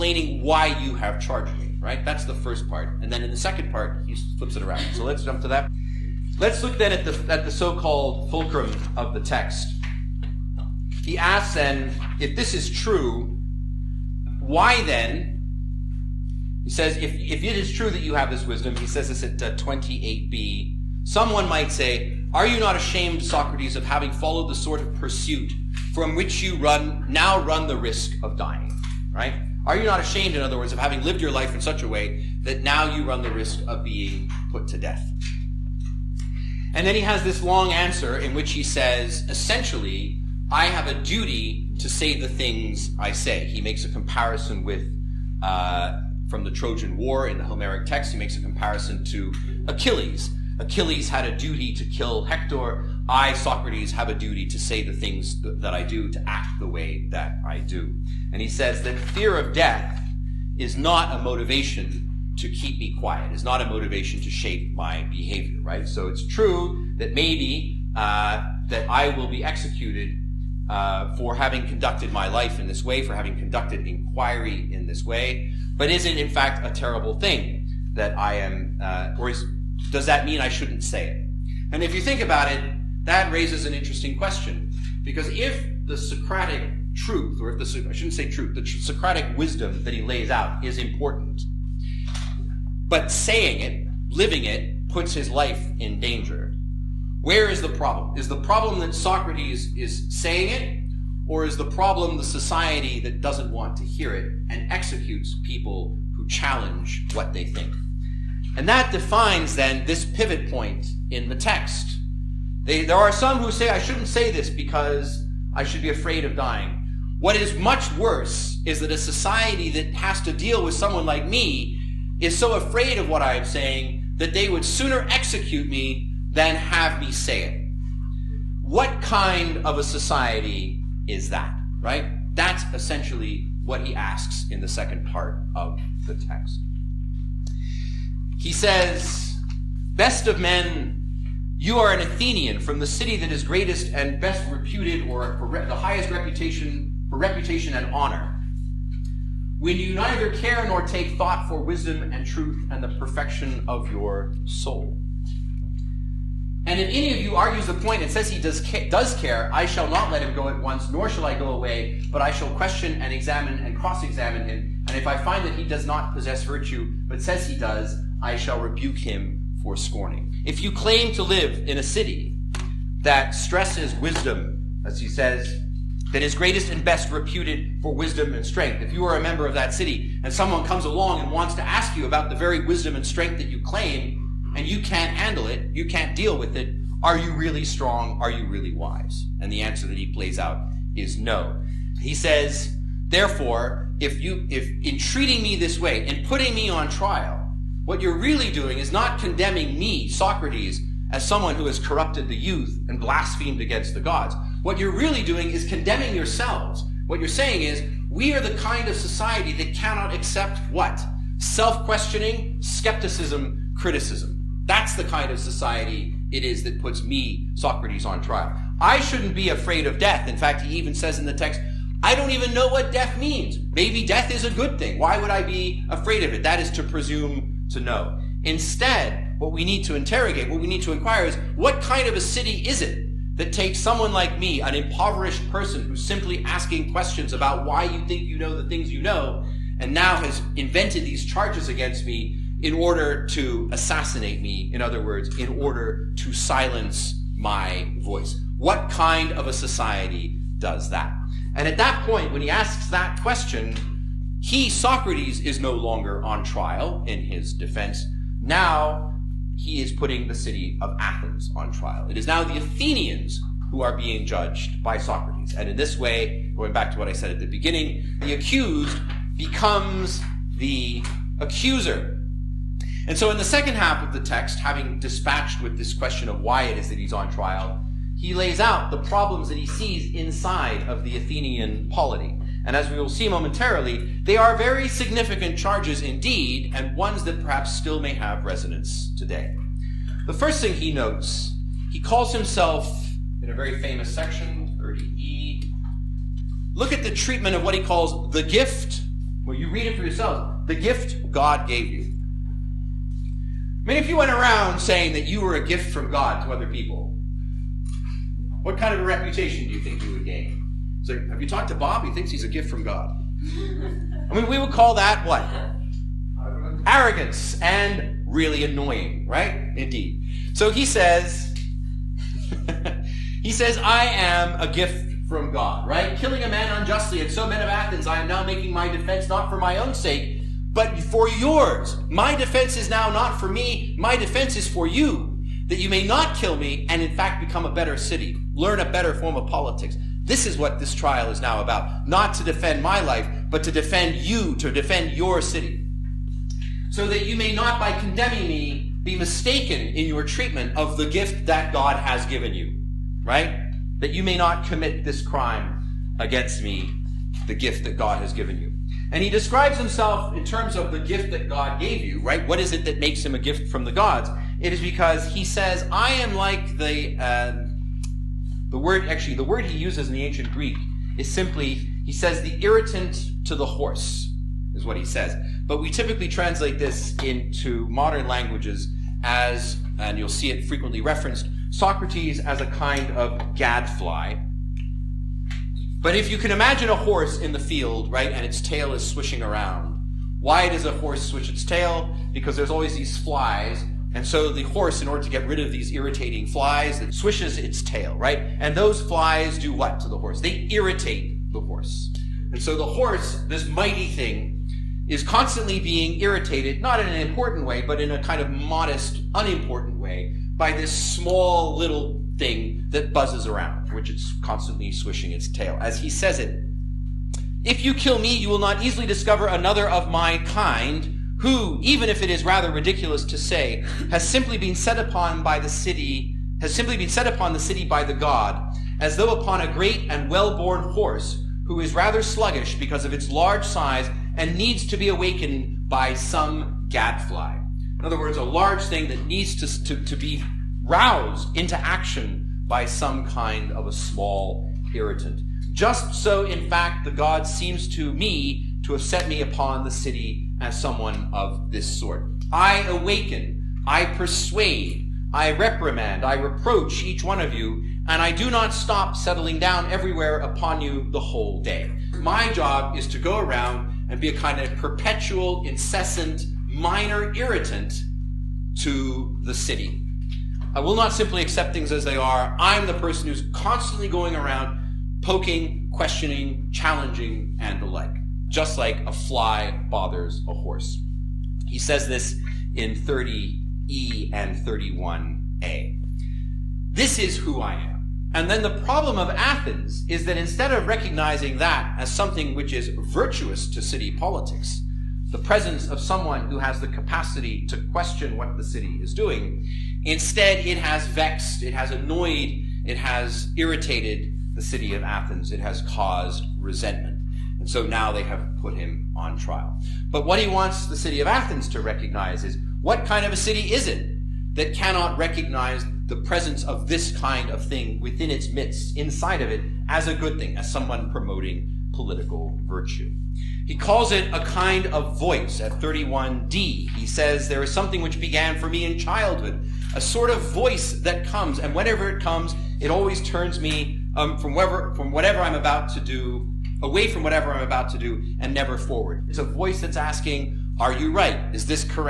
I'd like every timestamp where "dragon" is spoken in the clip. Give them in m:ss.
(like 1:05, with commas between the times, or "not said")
not said.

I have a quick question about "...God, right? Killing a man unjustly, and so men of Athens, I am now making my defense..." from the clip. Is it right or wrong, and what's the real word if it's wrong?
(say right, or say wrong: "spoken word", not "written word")
right.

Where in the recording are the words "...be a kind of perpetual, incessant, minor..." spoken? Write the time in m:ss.
7:44.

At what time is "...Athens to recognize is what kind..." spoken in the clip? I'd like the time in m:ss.
8:31.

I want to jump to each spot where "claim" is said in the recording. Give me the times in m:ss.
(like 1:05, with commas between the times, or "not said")
2:50, 3:03.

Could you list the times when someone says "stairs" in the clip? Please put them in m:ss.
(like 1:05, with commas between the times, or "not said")
not said.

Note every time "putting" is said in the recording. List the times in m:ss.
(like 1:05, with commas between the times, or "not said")
3:16, 4:19.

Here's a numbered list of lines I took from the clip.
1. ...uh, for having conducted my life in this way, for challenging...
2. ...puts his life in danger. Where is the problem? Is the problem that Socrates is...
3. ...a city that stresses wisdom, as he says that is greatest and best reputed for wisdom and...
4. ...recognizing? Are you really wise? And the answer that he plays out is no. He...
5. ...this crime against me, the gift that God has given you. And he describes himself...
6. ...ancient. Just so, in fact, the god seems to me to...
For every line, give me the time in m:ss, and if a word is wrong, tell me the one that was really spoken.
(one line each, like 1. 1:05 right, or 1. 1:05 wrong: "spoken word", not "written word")
1. 1:10 wrong: "having", not "challenging"
2. 1:34 right
3. 2:51 right
4. 3:07 wrong: "strong", not "recognizing"
5. 5:55 right
6. 7:24 wrong: "irritant", not "ancient".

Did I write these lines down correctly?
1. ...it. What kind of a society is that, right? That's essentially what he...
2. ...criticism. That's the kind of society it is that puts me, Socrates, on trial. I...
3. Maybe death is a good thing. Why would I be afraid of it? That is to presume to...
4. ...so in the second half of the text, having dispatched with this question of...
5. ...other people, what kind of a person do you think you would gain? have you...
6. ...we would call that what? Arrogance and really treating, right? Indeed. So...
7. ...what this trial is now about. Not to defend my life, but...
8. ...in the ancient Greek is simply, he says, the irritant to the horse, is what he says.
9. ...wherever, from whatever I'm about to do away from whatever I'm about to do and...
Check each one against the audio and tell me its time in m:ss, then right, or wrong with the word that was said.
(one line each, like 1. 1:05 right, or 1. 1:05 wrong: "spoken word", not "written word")
1. 2:07 right
2. 3:33 right
3. 3:43 right
4. 4:33 right
5. 5:06 wrong: "reputation", not "person"
6. 5:14 wrong: "annoying", not "treating"
7. 5:40 right
8. 6:10 right
9. 8:54 right.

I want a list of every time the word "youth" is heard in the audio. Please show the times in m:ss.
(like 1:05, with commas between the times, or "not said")
3:22.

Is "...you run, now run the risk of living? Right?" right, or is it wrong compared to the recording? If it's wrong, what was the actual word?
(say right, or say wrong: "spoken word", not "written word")
wrong: "dying", not "living".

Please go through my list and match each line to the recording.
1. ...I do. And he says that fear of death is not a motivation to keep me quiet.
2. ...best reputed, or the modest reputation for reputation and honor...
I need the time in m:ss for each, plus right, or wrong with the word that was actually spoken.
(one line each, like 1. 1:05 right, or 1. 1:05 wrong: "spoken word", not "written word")
1. 0:57 right
2. 2:24 wrong: "highest", not "modest".